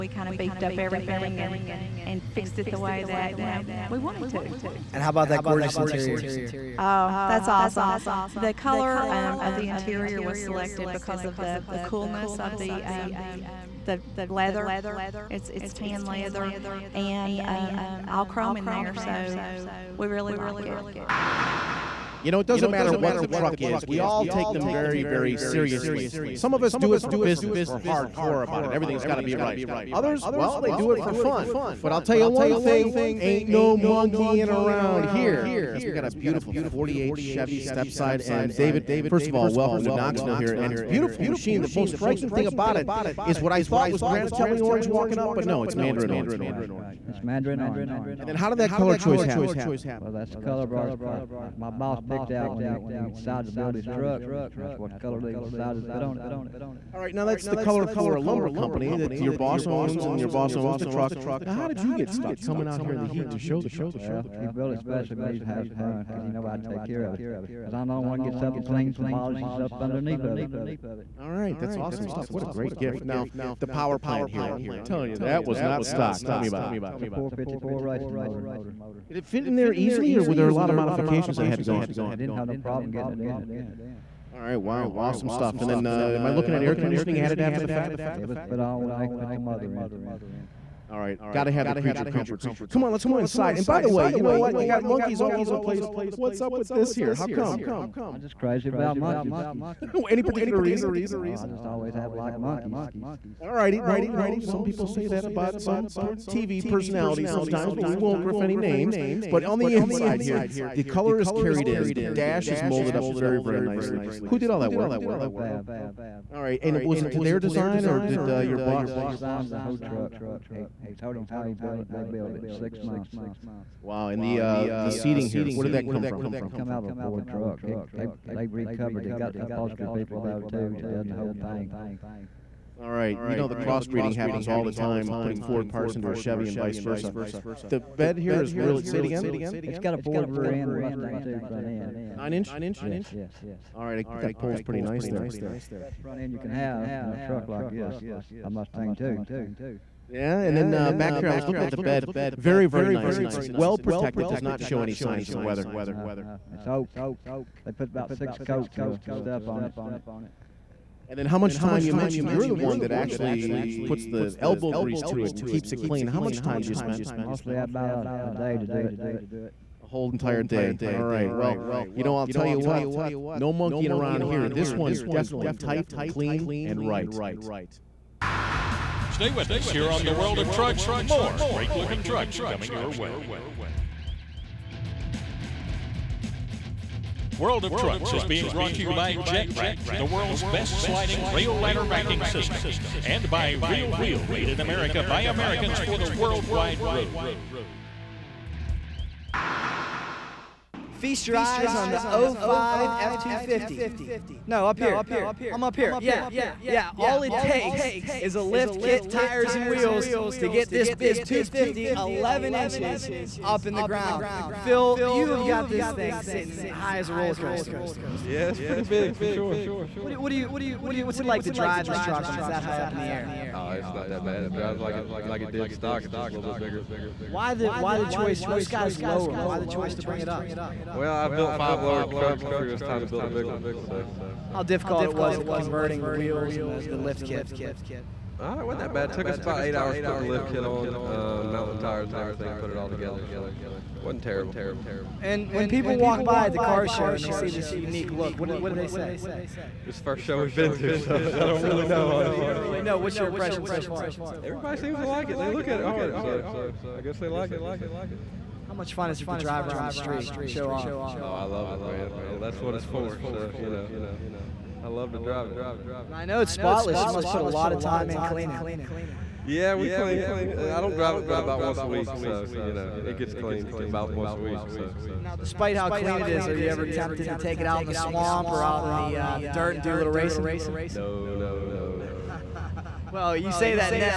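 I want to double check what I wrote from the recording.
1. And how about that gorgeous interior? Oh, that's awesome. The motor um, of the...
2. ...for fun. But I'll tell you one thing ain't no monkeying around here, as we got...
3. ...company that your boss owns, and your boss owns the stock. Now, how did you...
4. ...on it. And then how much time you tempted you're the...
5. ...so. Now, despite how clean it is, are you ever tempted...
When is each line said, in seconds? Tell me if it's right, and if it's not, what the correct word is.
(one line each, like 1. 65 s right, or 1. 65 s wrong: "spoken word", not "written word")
1. 4 s wrong: "color", not "motor"
2. 30 s right
3. 58 s wrong: "truck", not "stock"
4. 159 s wrong: "mentioned", not "tempted"
5. 274 s right.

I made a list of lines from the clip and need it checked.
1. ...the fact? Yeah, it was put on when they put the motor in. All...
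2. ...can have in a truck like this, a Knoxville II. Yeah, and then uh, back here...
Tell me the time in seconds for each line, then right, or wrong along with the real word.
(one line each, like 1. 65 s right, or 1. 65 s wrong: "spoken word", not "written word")
1. 87 s right
2. 146 s wrong: "Mustang", not "Knoxville".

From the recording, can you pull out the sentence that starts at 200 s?
Feast your eyes on the 05 F250.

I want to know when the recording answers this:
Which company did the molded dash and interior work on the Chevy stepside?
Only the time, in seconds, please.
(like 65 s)
115 s.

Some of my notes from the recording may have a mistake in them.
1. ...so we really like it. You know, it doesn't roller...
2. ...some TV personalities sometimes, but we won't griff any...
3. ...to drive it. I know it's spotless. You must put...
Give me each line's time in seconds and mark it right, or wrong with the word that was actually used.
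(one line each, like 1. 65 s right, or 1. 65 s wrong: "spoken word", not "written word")
1. 18 s wrong: "matter", not "roller"
2. 105 s right
3. 265 s right.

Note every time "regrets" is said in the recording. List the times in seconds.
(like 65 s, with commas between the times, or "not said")
not said.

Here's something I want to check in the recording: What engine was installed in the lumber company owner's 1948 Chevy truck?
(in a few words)
454 racing motor.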